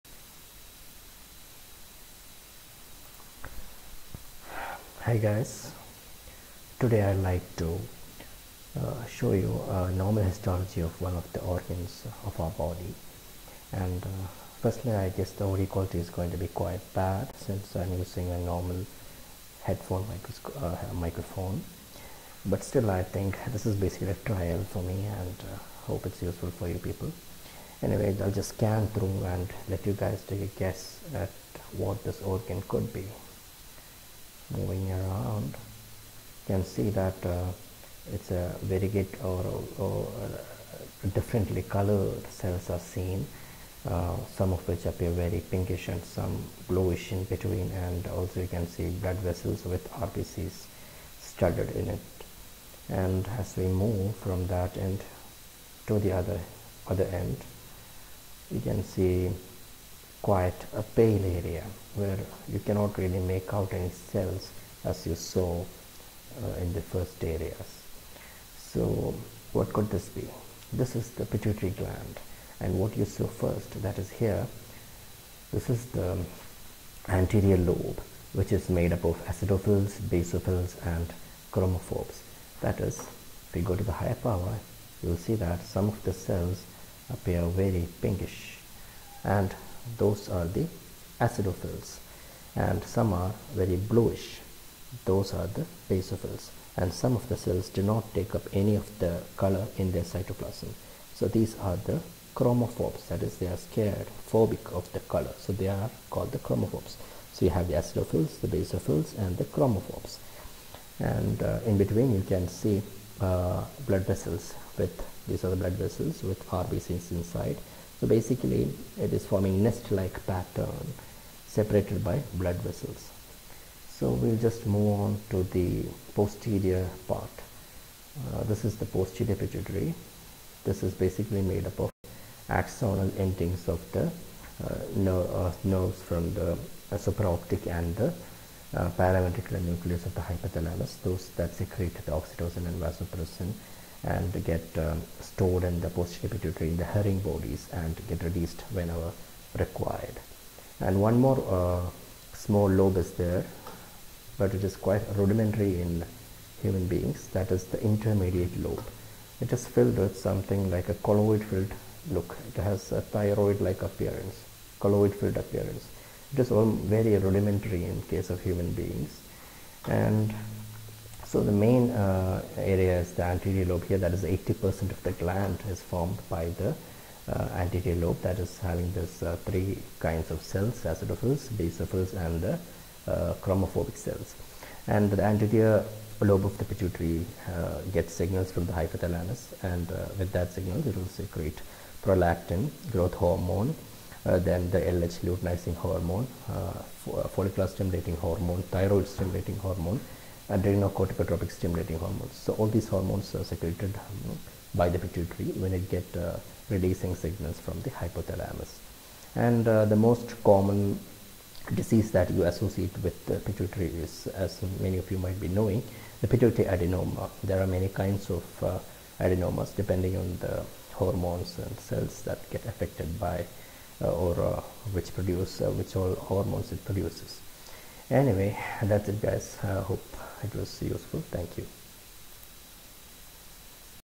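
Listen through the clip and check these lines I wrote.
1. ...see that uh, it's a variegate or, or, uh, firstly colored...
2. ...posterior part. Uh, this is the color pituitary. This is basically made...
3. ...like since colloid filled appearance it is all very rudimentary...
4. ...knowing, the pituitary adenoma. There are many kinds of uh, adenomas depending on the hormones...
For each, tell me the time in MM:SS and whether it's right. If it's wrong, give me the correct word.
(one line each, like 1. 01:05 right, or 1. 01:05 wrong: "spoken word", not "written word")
1. 00:36 wrong: "differently", not "firstly"
2. 02:06 wrong: "posterior", not "color"
3. 02:43 wrong: "appearance", not "since"
4. 03:35 right.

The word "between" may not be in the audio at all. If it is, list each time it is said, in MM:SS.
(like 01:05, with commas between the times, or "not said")
00:47, 01:51.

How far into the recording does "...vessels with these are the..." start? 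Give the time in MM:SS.
01:54.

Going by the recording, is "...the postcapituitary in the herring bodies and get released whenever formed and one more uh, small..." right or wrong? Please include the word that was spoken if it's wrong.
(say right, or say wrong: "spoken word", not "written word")
wrong: "required", not "formed".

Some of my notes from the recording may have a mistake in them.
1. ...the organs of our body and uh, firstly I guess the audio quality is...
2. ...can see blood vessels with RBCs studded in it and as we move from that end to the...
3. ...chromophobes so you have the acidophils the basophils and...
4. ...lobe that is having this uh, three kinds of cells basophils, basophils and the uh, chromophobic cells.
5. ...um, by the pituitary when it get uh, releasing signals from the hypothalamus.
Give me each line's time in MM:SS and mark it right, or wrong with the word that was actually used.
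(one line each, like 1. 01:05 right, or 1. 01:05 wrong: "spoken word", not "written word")
1. 00:11 right
2. 00:48 right
3. 01:46 right
4. 02:58 wrong: "acidophils", not "basophils"
5. 03:23 right.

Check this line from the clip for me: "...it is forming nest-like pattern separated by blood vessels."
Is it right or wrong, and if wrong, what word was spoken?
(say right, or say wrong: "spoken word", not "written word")
right.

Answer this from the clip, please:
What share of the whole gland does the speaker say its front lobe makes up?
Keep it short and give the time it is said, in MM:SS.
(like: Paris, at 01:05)
80%, at 02:54.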